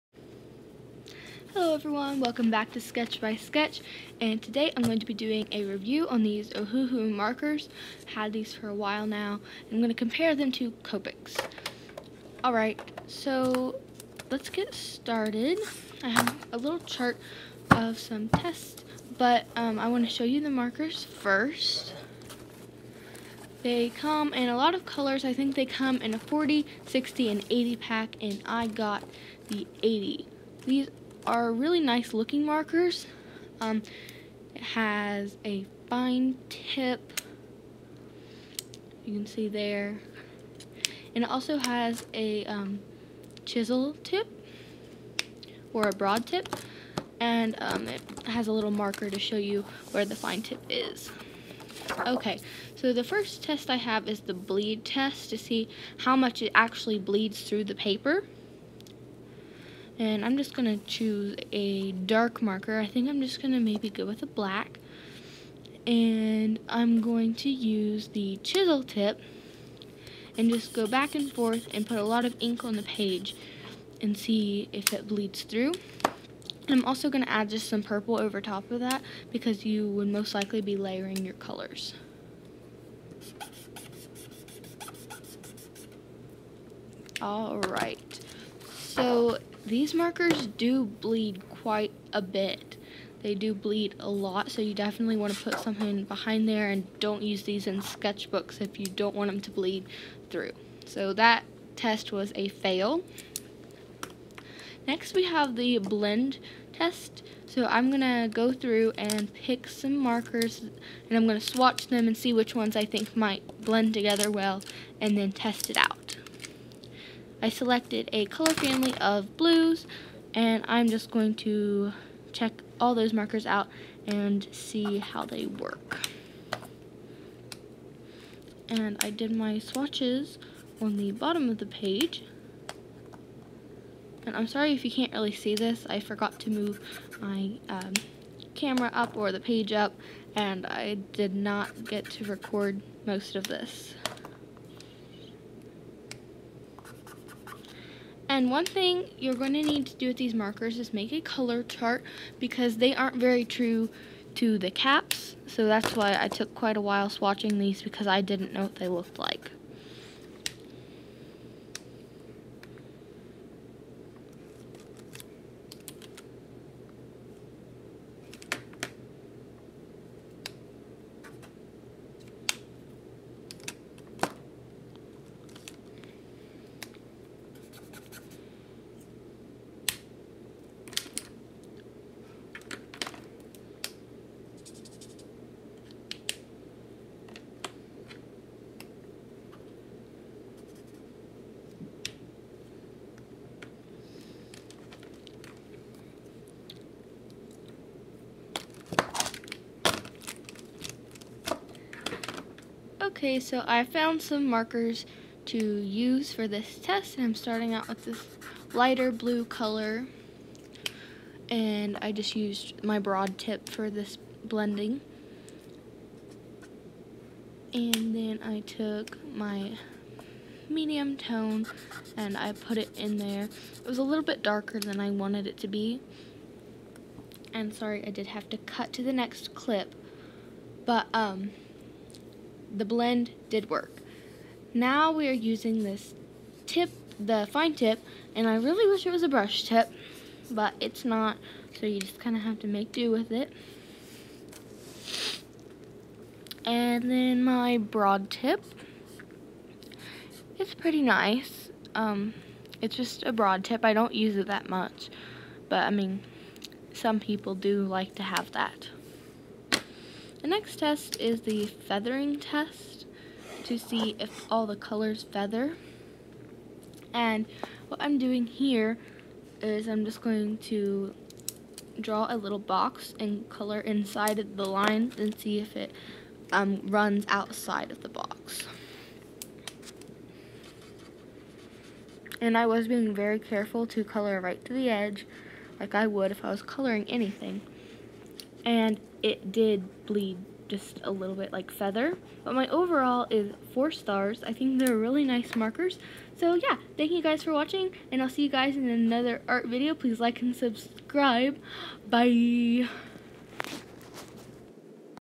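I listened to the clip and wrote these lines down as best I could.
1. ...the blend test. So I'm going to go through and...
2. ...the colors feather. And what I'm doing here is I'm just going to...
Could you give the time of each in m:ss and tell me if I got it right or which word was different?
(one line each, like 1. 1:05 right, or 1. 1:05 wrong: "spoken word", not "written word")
1. 1:45 right
2. 4:24 right.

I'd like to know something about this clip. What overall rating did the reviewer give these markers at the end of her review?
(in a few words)
4 stars.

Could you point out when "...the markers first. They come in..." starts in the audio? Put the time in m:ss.
0:20.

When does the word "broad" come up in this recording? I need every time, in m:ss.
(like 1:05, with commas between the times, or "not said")
0:45, 3:32, 4:07, 4:13.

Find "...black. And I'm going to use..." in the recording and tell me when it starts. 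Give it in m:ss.
1:04.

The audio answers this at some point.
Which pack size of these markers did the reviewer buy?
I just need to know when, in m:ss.
0:28.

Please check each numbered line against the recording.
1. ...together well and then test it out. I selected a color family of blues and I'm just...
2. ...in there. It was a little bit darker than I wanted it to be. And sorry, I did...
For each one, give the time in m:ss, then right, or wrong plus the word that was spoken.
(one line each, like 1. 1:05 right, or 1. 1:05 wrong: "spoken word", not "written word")
1. 1:53 right
2. 3:42 right.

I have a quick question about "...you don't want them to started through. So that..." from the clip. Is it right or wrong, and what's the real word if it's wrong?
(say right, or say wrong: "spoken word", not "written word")
wrong: "bleed", not "started".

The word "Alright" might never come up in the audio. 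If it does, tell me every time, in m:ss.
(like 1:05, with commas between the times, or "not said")
0:12, 1:27.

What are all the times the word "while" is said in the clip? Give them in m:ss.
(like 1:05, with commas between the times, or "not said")
0:08, 2:36.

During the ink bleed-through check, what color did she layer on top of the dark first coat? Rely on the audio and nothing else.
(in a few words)
Purple.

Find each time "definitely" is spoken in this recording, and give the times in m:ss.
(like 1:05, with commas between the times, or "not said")
1:34.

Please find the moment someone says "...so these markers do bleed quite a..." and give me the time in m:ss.
1:28.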